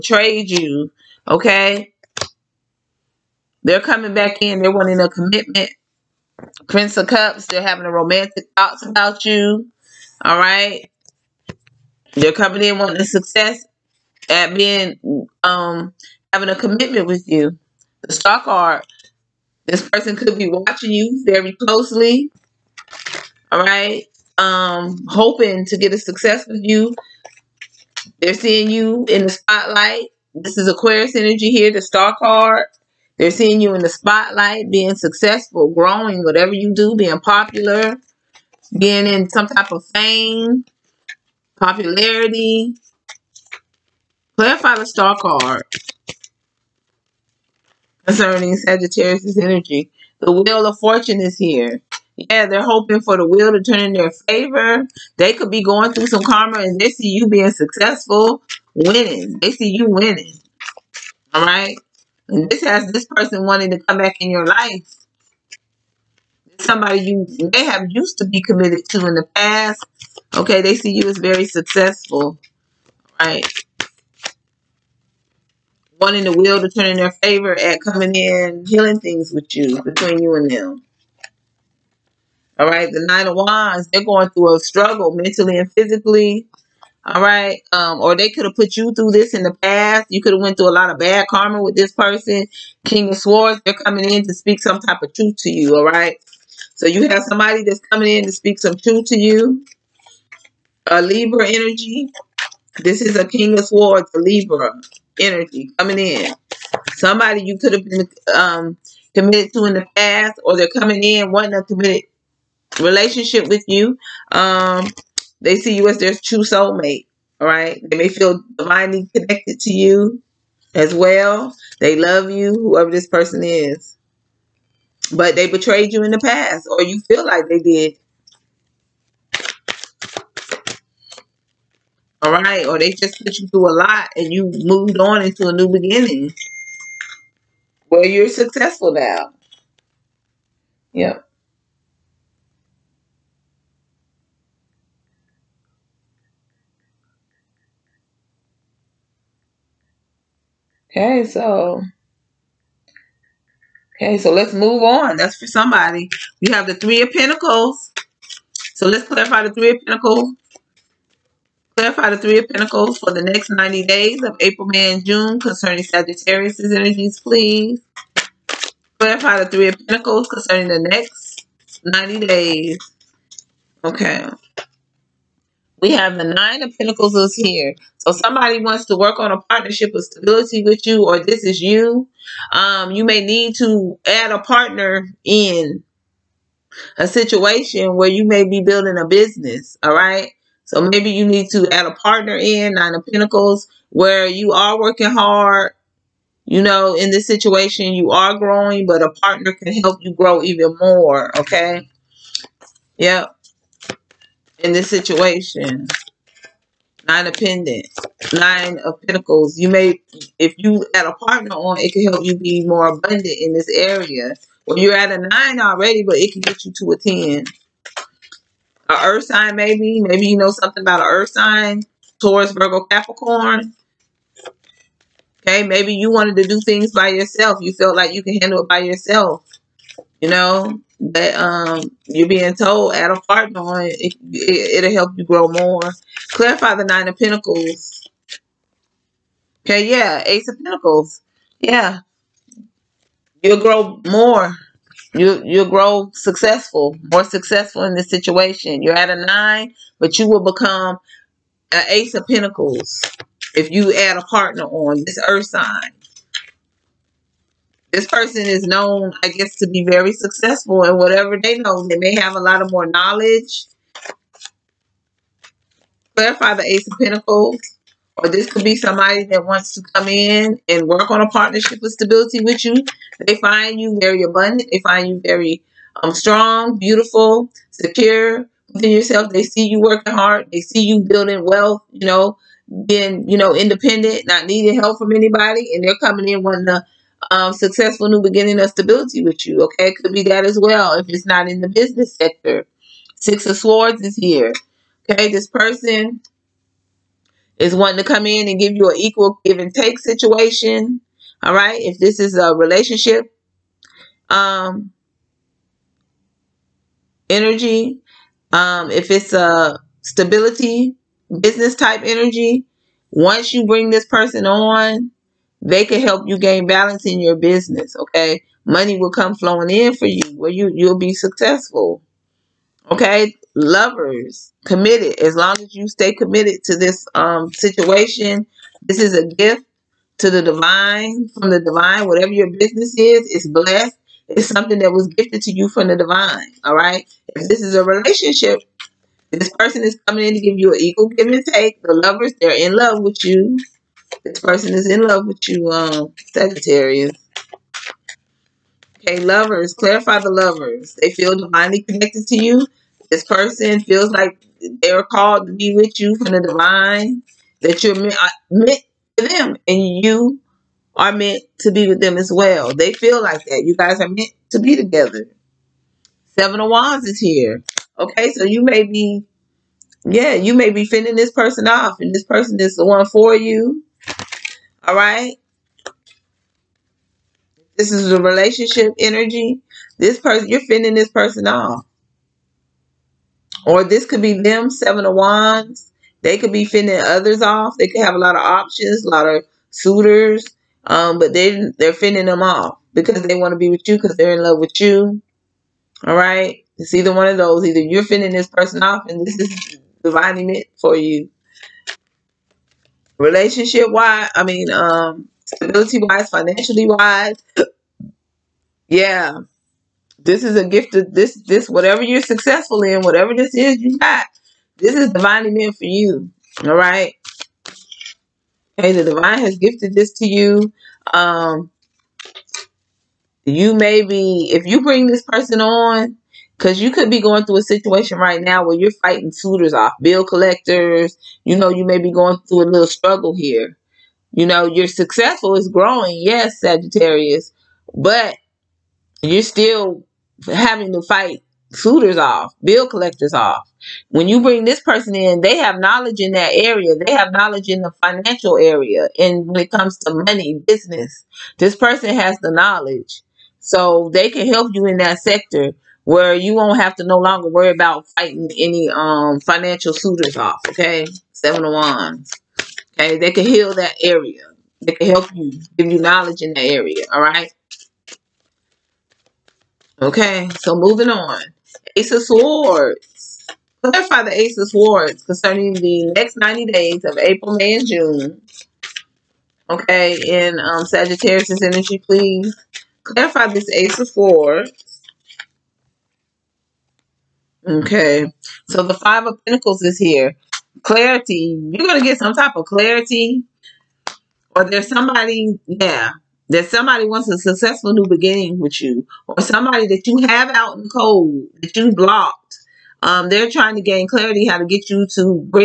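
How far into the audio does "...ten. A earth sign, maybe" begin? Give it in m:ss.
3:36.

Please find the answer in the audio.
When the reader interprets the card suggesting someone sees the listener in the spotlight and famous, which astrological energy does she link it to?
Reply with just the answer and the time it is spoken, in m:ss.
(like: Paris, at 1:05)
Aquarius, at 0:30.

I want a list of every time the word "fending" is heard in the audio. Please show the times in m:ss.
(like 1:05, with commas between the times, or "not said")
6:10, 6:20, 6:26, 6:31, 6:38.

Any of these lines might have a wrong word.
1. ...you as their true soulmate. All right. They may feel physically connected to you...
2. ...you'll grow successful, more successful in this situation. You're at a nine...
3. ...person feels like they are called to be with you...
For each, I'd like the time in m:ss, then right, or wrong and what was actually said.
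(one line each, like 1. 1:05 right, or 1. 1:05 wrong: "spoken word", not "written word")
1. 1:55 wrong: "divinely", not "physically"
2. 4:05 right
3. 5:53 right.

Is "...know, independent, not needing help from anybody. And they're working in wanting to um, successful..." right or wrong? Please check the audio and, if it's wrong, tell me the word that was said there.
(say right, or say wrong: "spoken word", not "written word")
wrong: "coming", not "working".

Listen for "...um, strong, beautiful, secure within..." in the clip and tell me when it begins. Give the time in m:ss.
4:36.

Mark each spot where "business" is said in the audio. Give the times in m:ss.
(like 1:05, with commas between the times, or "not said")
3:09, 4:51, 5:11, 5:17, 5:32, 7:30.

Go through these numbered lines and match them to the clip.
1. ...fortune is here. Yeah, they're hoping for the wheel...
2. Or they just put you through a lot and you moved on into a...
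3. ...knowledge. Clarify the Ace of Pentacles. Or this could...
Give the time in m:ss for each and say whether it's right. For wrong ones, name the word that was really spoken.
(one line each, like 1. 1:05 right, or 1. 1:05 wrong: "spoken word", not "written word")
1. 0:50 right
2. 2:12 right
3. 4:22 right.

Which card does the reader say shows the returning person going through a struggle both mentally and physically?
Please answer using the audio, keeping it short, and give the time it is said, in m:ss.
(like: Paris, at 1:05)
Nine of Wands, at 1:22.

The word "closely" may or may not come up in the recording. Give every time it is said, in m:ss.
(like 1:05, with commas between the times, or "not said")
0:21.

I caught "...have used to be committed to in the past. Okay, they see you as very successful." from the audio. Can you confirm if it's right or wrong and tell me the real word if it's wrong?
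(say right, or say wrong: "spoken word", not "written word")
right.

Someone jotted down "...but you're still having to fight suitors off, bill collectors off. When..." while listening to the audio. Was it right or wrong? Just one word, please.
right.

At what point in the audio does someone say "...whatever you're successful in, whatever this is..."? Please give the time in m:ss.
6:51.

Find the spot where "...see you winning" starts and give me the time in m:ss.
0:59.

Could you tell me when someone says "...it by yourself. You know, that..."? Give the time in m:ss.
3:48.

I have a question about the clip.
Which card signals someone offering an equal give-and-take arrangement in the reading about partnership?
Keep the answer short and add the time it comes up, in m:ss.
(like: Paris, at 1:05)
Six of Swords, at 4:53.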